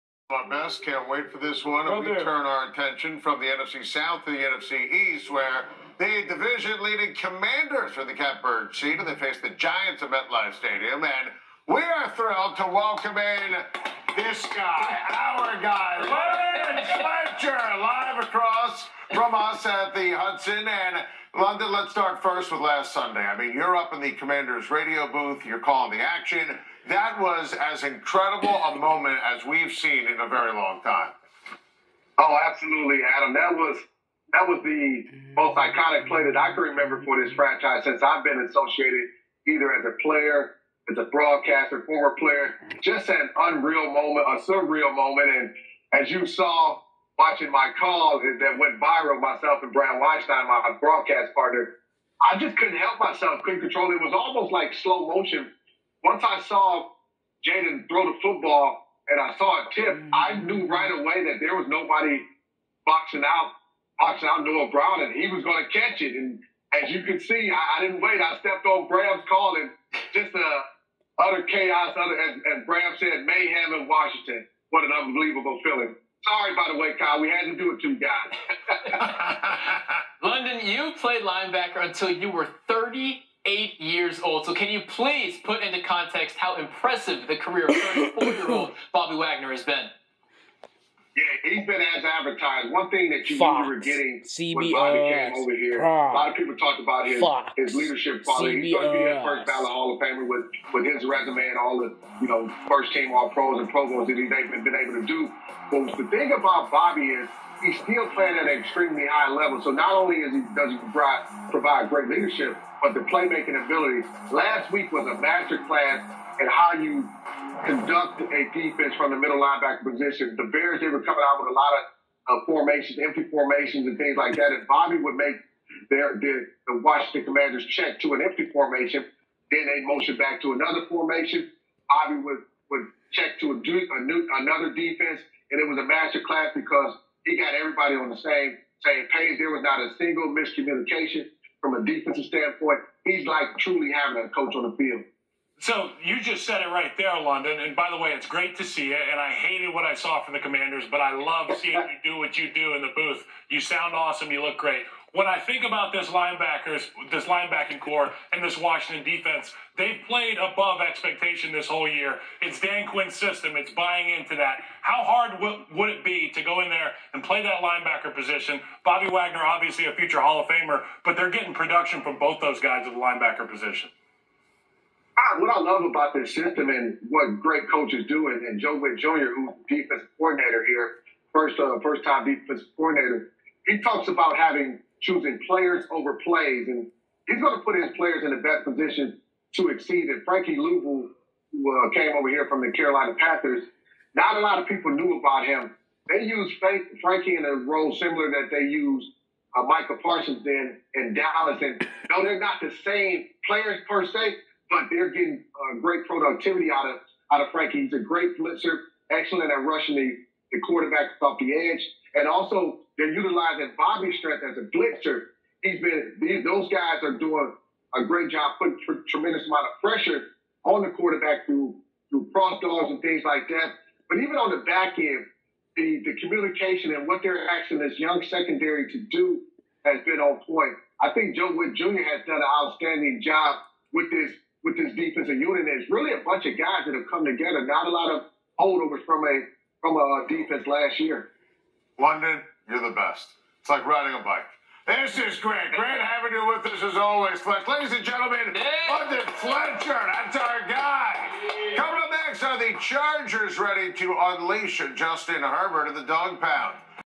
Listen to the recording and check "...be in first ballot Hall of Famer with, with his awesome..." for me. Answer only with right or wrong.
wrong.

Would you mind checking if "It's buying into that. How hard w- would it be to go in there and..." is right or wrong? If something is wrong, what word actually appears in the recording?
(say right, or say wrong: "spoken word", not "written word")
right.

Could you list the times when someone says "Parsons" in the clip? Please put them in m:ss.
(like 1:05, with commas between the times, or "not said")
3:20.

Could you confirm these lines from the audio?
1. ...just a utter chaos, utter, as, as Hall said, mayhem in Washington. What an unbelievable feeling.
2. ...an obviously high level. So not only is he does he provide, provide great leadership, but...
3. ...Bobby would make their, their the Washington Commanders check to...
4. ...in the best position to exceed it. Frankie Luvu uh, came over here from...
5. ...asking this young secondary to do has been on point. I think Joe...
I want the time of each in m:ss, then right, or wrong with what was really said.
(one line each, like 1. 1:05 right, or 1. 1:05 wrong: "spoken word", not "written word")
1. 1:10 wrong: "Bram", not "Hall"
2. 1:48 wrong: "extremely", not "obviously"
3. 2:04 right
4. 3:08 right
5. 3:47 right.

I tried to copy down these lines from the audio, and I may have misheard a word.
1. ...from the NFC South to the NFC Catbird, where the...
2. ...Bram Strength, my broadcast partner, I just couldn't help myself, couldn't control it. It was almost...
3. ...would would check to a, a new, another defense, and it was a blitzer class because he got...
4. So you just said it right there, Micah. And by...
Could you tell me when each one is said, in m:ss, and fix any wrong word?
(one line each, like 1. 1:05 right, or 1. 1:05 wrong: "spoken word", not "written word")
1. 0:03 wrong: "East", not "Catbird"
2. 0:49 wrong: "Weinstein", not "Strength"
3. 2:12 wrong: "master", not "blitzer"
4. 2:25 wrong: "London", not "Micah".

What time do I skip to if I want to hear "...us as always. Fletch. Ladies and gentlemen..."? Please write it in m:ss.
4:06.